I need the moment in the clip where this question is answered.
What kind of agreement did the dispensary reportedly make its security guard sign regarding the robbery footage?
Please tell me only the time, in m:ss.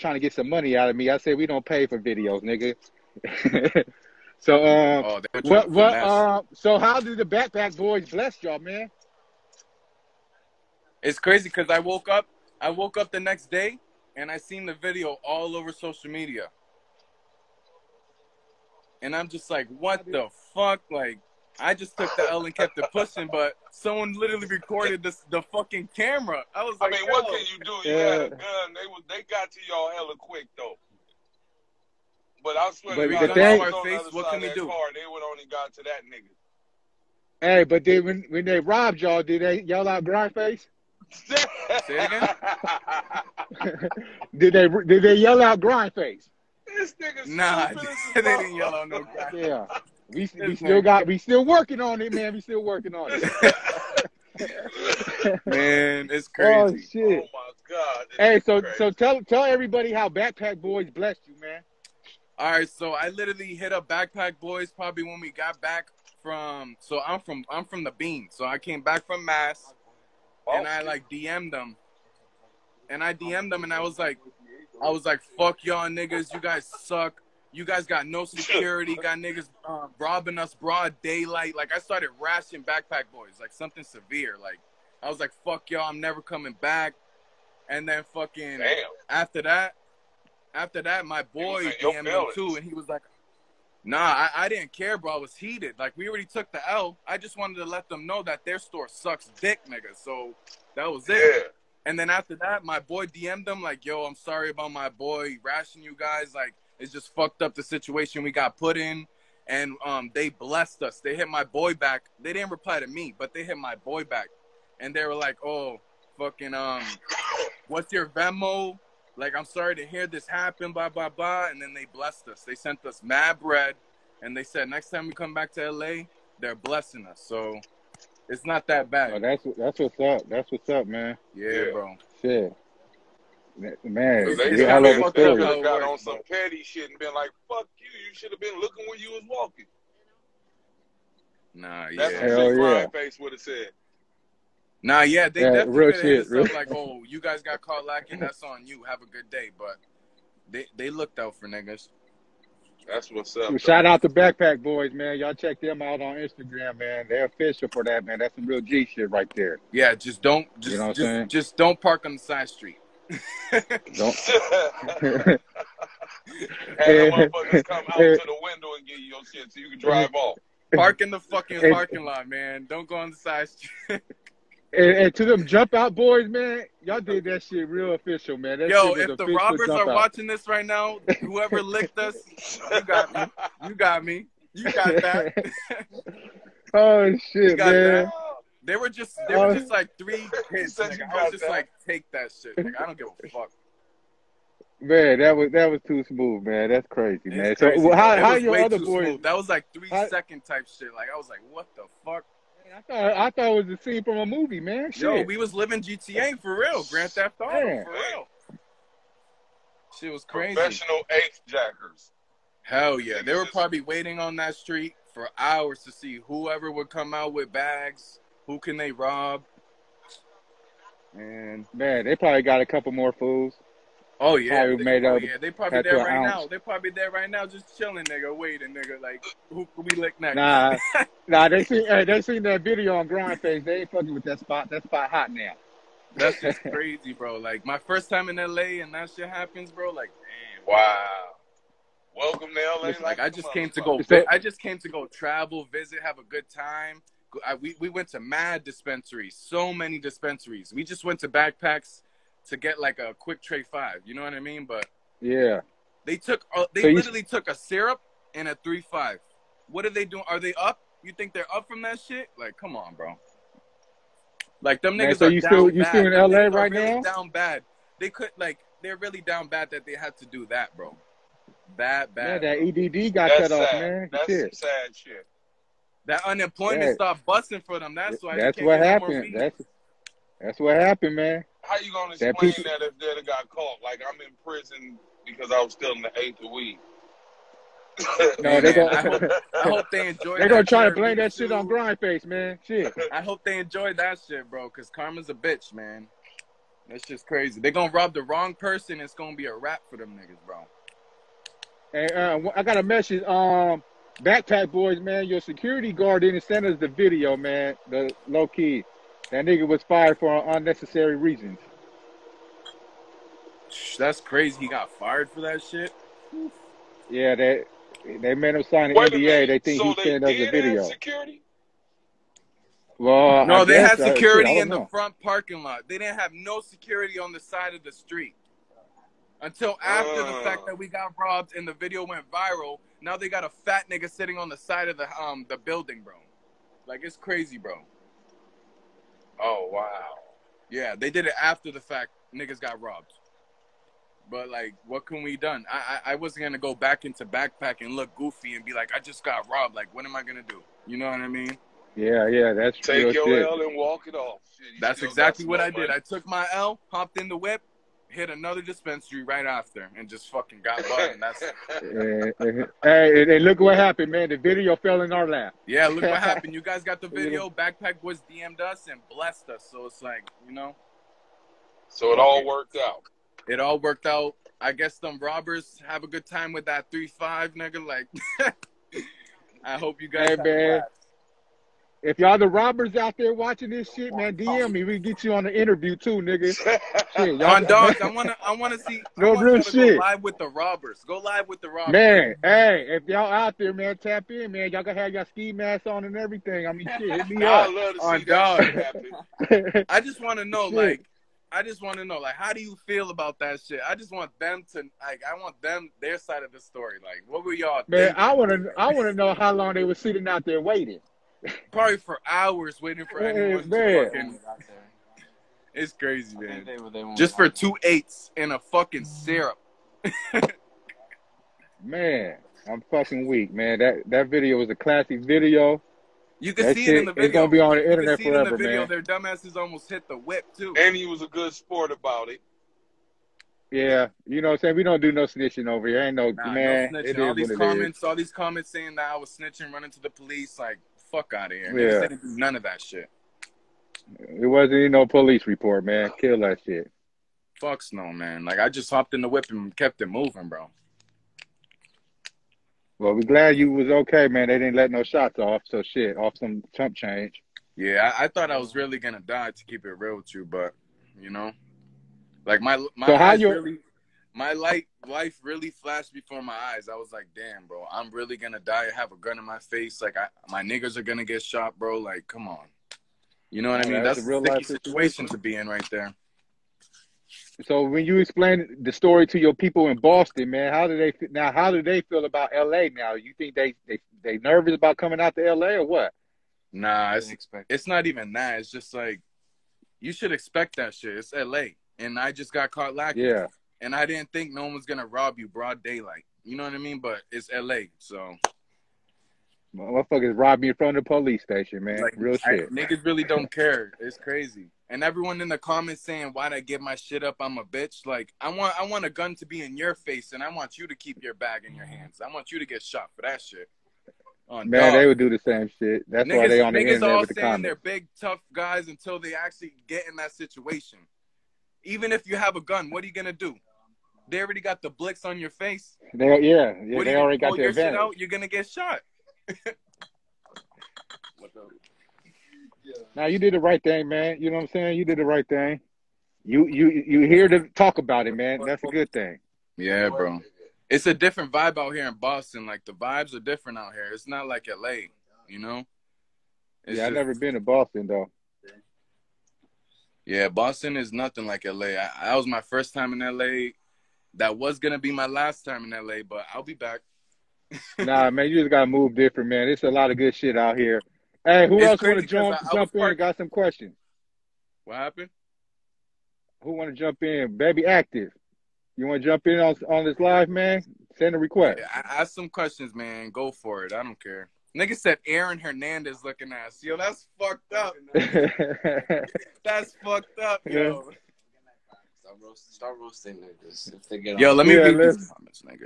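5:18.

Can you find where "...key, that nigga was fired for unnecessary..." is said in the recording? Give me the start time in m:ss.
5:08.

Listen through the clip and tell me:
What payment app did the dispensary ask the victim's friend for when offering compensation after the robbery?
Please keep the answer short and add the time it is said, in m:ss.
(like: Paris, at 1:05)
Venmo, at 1:58.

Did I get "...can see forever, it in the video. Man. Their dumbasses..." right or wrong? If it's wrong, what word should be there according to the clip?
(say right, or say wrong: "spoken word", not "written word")
right.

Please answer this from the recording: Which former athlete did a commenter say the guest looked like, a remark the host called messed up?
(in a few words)
Aaron Hernandez.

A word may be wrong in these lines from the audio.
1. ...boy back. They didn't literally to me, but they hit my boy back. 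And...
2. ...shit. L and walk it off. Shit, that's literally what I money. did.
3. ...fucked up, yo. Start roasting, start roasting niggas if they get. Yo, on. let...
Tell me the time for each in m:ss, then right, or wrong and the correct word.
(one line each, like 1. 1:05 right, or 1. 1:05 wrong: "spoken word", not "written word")
1. 1:51 wrong: "reply", not "literally"
2. 5:53 wrong: "exactly", not "literally"
3. 9:40 right.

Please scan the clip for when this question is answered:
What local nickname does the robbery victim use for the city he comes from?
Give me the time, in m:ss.
1:07.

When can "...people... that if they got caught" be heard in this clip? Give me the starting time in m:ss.
4:42.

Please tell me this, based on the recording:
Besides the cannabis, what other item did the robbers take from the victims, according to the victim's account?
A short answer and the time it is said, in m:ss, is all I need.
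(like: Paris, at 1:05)
a syrup, at 4:17.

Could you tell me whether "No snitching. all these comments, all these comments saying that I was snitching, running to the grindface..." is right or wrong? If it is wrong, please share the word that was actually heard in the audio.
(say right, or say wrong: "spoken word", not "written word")
wrong: "police", not "grindface".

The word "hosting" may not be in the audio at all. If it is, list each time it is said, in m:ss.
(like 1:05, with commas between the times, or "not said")
not said.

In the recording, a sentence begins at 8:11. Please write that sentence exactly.
It's LA, and I just got caught lacking.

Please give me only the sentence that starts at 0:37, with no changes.
Hey, but then when, when they robbed y'all, did they yell out grindface?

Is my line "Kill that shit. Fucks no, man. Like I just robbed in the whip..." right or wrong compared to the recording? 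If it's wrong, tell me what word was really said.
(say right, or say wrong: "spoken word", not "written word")
wrong: "hopped", not "robbed".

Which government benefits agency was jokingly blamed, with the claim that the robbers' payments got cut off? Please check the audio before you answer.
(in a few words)
EDD.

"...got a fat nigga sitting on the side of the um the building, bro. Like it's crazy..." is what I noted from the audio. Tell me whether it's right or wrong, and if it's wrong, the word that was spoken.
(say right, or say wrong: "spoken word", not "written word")
right.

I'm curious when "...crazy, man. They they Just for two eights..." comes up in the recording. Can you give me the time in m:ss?
6:55.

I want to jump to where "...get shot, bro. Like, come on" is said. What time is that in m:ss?
7:51.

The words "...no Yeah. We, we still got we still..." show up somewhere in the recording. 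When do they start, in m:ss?
0:48.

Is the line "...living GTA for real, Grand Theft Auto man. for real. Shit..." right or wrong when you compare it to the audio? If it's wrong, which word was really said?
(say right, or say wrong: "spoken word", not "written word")
right.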